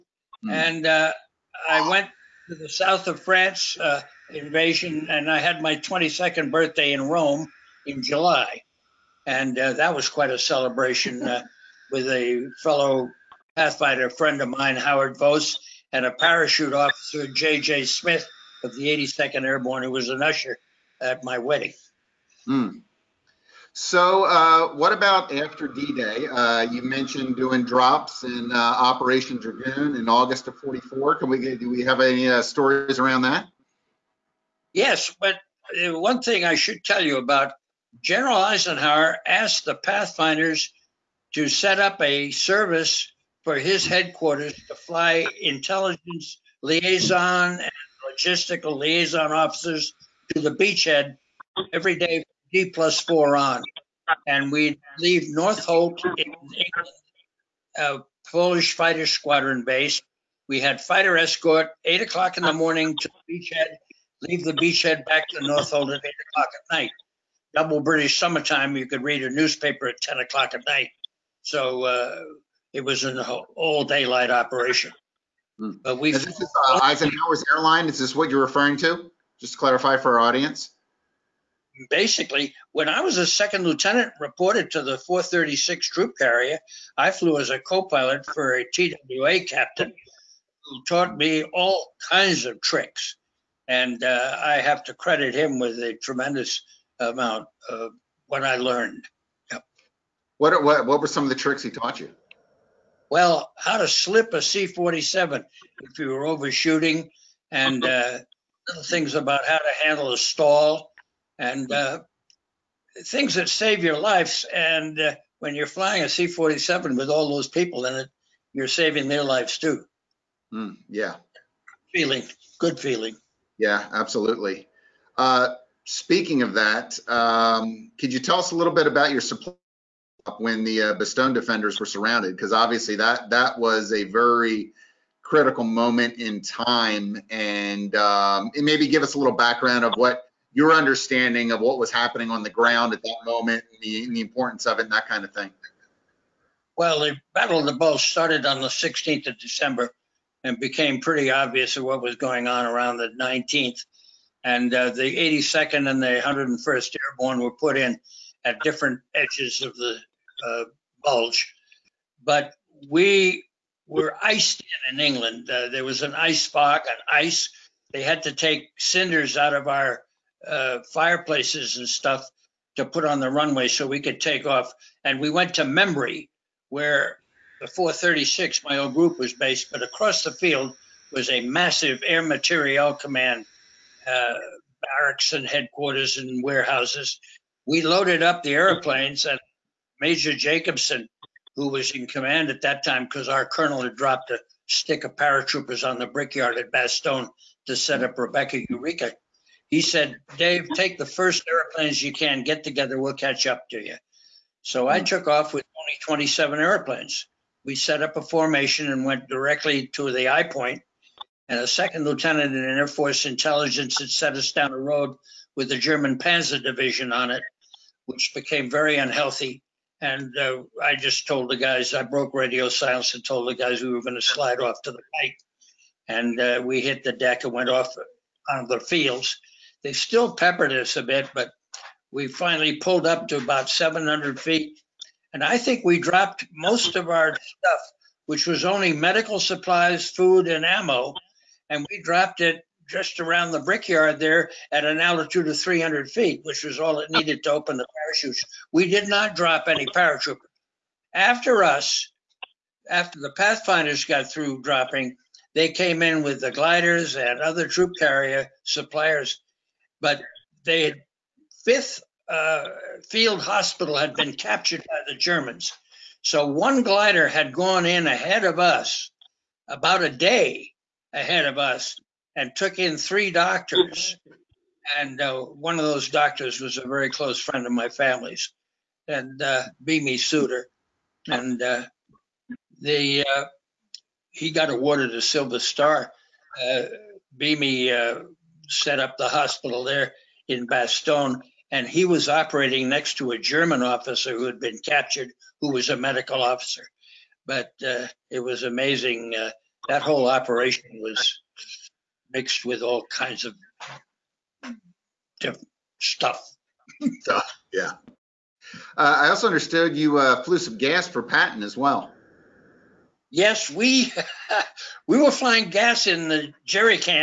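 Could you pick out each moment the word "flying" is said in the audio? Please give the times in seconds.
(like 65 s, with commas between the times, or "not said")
115 s, 315 s.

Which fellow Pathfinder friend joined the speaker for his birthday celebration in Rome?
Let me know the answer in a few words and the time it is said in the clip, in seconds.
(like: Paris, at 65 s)
Howard Vos, at 14 s.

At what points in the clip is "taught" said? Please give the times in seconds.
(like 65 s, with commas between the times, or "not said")
90 s, 101 s.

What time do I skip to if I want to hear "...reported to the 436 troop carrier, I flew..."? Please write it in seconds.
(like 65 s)
84 s.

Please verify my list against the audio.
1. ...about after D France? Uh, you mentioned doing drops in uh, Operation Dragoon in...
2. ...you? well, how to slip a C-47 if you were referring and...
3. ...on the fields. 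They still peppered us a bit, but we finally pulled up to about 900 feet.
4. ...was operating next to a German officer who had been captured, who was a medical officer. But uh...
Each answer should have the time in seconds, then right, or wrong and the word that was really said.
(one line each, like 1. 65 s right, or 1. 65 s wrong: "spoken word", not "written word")
1. 24 s wrong: "Day", not "France"
2. 101 s wrong: "overshooting", not "referring"
3. 228 s wrong: "700", not "900"
4. 292 s right.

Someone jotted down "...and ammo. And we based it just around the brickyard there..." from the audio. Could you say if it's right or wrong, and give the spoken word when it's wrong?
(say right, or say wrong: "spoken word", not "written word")
wrong: "dropped", not "based".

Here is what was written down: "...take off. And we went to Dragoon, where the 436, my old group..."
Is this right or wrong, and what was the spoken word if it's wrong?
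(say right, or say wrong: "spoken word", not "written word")
wrong: "Membury", not "Dragoon".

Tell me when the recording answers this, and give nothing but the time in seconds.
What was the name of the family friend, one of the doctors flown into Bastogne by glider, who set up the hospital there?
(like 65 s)
279 s.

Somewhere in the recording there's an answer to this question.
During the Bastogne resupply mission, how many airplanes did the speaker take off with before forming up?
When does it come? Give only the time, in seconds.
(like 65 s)
206 s.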